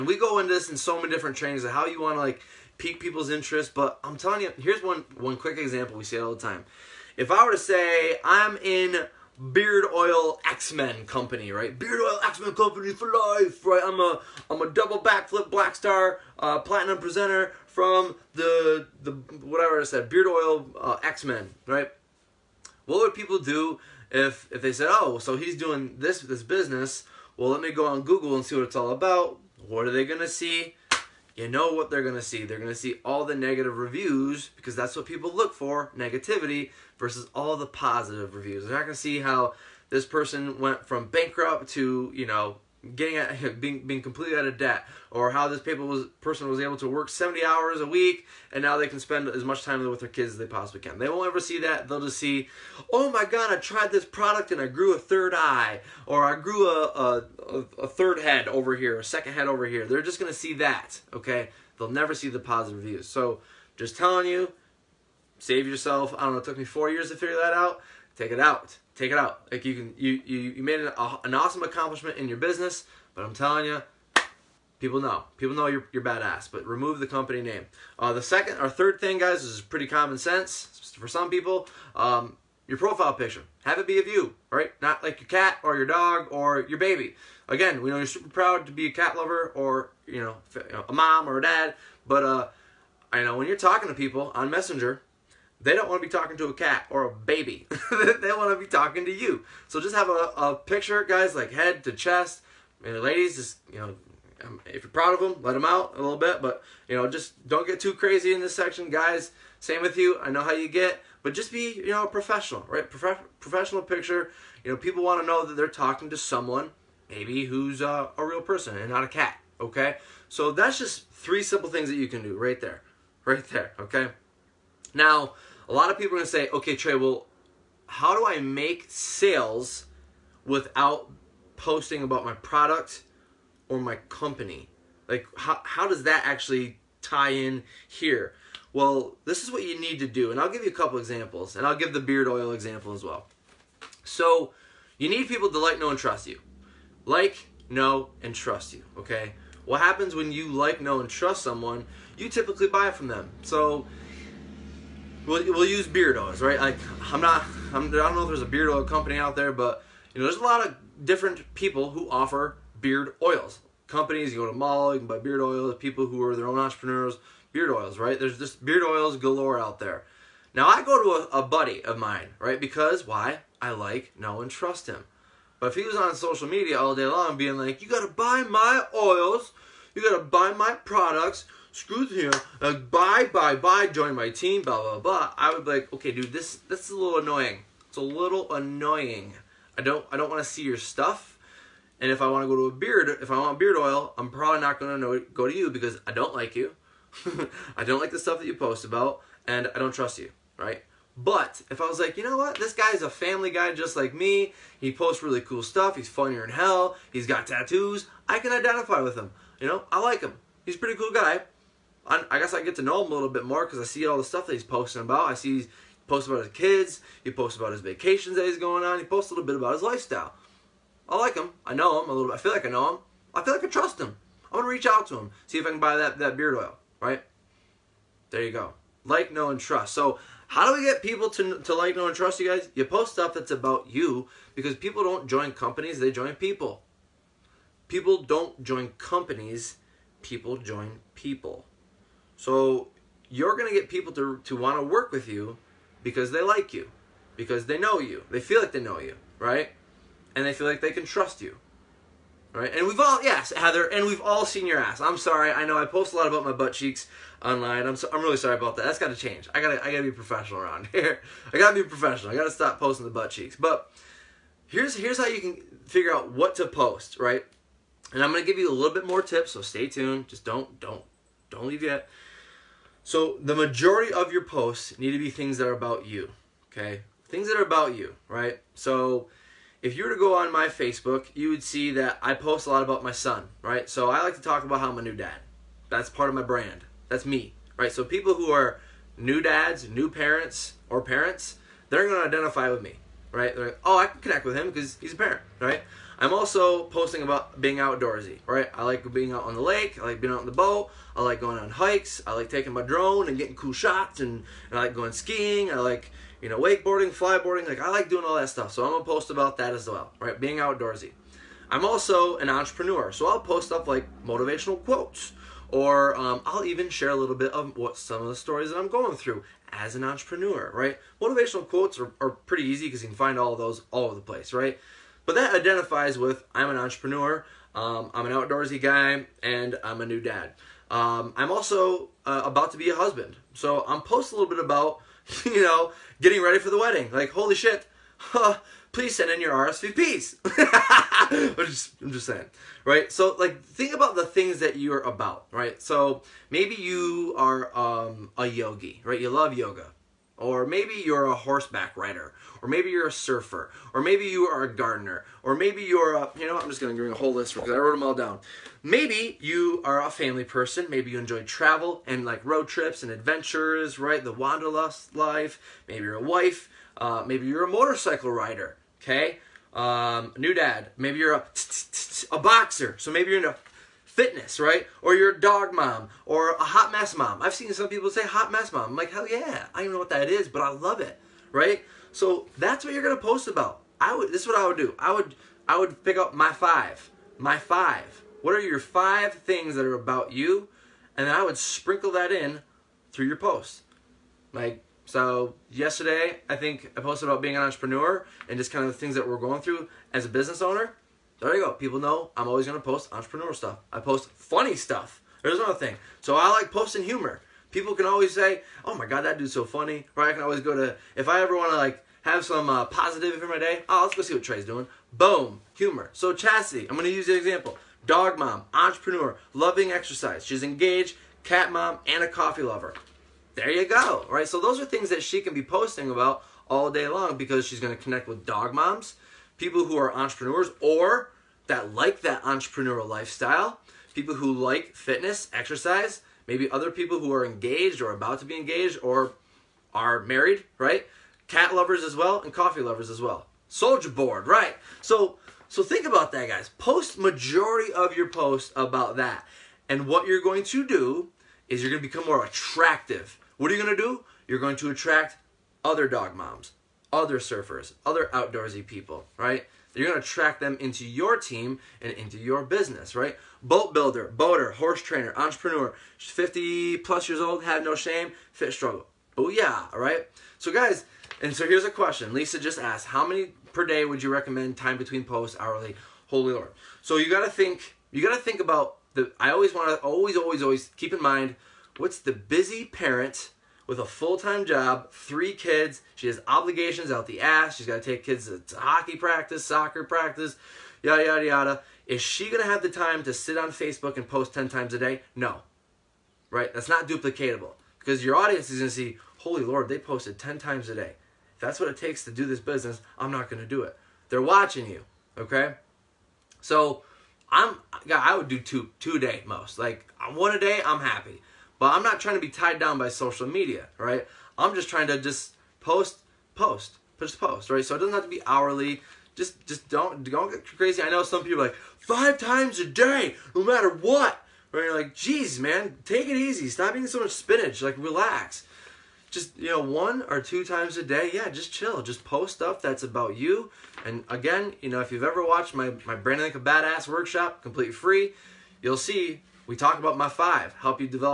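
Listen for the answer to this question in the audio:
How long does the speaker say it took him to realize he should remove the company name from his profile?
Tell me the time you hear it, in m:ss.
1:06.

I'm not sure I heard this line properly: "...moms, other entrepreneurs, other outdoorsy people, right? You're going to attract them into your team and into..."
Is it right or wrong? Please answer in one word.
wrong.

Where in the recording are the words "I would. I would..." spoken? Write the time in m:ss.
6:24.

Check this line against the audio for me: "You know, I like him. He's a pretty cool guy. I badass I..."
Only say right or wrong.
wrong.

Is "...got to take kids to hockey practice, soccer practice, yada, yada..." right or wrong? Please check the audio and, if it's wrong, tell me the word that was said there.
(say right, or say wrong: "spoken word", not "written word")
right.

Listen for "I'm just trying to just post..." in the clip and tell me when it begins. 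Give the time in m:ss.
8:34.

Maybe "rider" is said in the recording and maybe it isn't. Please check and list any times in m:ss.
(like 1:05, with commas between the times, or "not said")
5:51, 6:08.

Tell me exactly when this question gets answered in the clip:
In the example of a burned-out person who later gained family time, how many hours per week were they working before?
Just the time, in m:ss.
0:47.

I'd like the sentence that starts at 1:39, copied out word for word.
So just have a, a picture, guys, like head to chest.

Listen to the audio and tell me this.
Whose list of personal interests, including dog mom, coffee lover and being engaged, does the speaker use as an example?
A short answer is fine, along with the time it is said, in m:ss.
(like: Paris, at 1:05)
Chastity, at 6:56.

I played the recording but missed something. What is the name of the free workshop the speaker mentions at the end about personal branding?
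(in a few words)
Brand Like a Badass.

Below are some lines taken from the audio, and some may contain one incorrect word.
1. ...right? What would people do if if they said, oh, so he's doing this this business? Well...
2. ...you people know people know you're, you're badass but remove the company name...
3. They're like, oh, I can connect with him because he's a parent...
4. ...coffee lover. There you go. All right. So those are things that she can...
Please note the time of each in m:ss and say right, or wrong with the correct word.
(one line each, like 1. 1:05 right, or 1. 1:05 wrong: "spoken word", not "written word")
1. 0:21 right
2. 1:13 right
3. 4:53 right
4. 7:02 right.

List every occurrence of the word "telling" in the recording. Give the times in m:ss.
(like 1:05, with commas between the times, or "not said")
0:04, 1:03, 1:13.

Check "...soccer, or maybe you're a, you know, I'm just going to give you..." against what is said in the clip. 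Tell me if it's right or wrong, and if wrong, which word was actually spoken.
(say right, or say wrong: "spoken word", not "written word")
wrong: "gardener", not "soccer".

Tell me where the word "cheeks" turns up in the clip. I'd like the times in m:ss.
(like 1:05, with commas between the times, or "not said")
4:16, 4:23.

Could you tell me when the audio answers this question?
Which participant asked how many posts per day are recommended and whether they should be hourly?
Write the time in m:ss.
7:52.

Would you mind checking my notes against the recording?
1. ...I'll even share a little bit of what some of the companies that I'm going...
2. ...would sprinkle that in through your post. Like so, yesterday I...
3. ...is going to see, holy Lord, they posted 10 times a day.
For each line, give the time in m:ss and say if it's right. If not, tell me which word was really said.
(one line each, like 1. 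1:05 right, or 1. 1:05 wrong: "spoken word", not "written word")
1. 5:16 wrong: "stories", not "companies"
2. 6:31 right
3. 8:18 right.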